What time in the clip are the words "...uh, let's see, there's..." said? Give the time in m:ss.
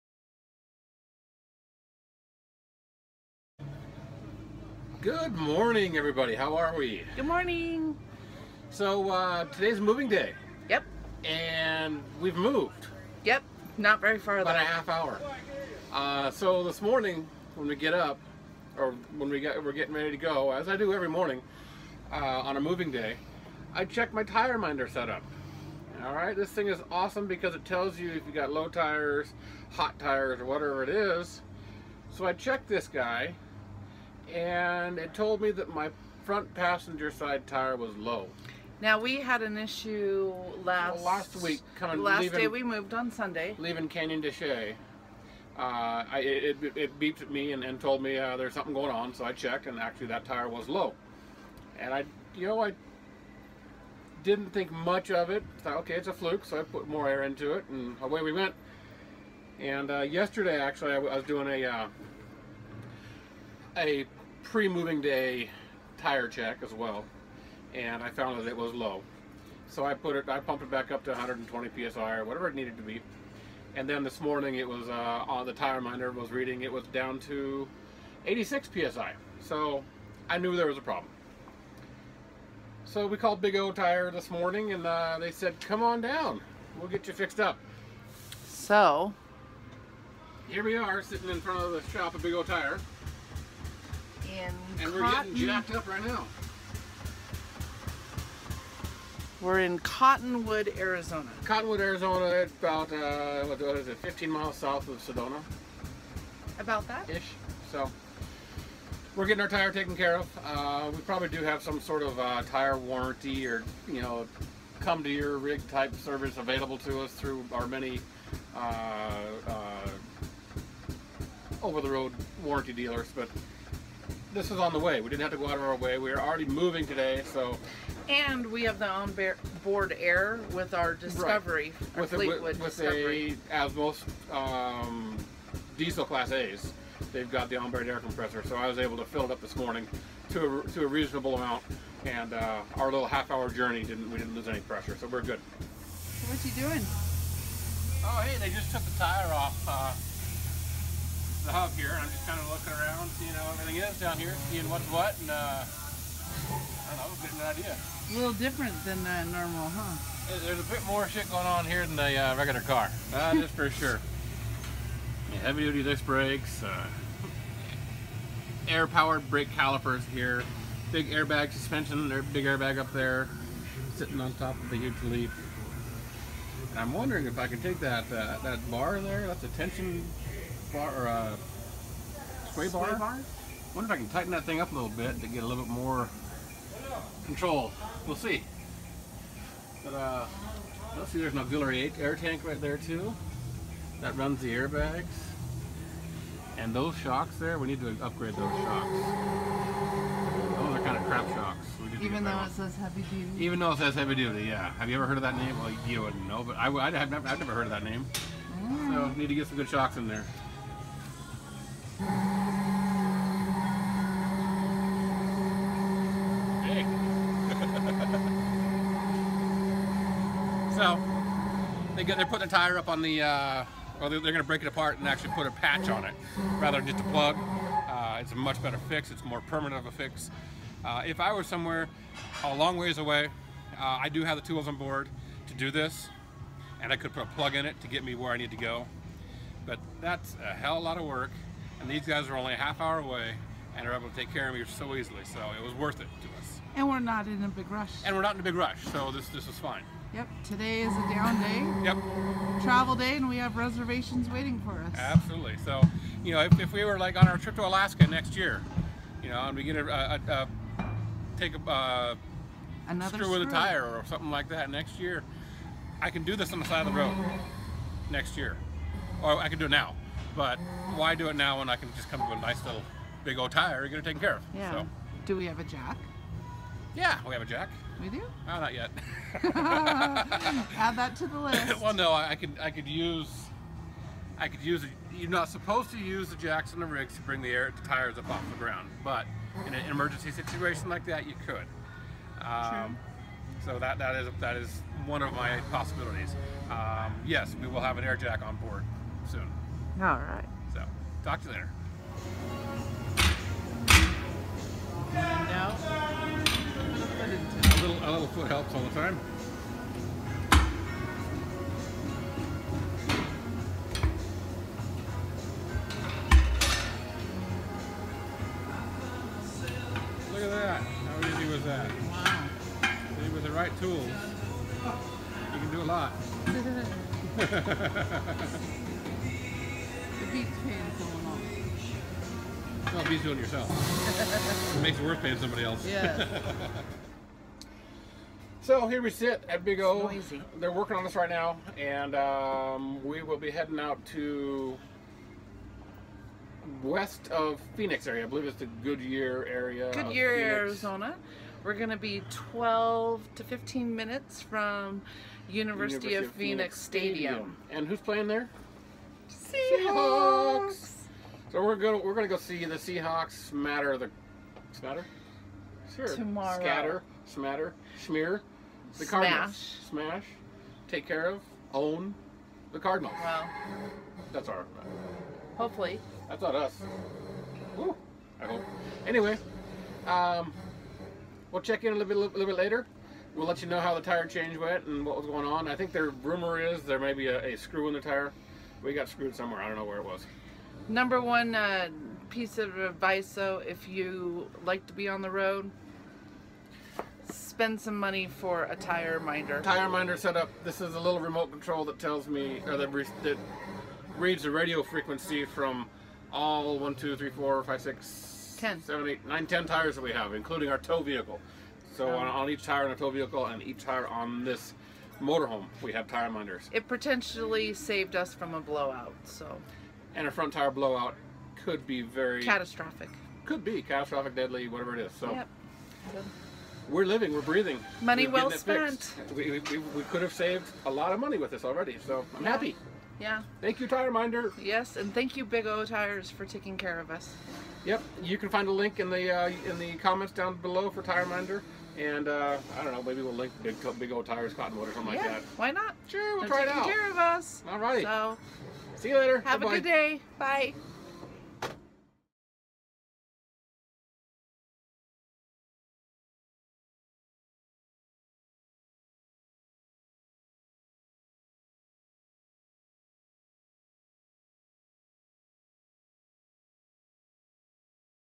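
3:09.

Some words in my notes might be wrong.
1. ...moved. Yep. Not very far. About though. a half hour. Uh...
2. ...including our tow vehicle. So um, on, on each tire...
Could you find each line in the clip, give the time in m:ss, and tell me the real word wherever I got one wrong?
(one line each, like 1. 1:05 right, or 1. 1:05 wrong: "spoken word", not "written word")
1. 0:12 right
2. 6:50 right.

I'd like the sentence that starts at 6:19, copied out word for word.
Anyway, um, we'll check in a little bit, a little bit later.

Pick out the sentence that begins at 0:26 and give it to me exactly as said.
All right, this thing is awesome because it tells you if you got low tires, hot tires, or whatever it is.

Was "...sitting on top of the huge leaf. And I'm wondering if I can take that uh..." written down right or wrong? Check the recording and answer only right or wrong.
right.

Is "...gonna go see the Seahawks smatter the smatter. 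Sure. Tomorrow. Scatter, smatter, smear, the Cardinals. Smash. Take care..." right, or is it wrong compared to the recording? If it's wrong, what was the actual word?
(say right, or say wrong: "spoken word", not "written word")
right.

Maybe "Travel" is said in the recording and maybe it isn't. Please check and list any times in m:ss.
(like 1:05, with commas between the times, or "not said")
4:12.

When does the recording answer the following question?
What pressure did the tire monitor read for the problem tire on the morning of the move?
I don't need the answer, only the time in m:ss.
1:18.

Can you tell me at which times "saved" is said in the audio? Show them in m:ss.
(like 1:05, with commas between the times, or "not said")
6:57, 7:10.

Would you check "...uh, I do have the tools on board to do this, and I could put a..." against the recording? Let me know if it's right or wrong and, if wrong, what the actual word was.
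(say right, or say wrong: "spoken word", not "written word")
right.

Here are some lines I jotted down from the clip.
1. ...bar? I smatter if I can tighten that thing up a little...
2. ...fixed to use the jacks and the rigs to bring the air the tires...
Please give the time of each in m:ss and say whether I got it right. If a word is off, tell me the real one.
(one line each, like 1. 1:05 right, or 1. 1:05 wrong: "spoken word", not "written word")
1. 3:02 wrong: "wonder", not "smatter"
2. 4:45 wrong: "supposed", not "fixed".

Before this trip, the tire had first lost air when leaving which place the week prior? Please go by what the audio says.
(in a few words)
Canyon de Chelly.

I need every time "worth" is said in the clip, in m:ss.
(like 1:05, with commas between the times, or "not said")
4:05, 5:35.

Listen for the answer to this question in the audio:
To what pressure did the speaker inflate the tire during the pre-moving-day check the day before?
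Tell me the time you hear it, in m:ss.
1:11.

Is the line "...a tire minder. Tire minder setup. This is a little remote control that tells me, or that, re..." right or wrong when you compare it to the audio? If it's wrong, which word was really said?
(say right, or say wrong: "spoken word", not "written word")
right.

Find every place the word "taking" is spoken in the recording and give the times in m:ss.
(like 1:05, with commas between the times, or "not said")
7:16.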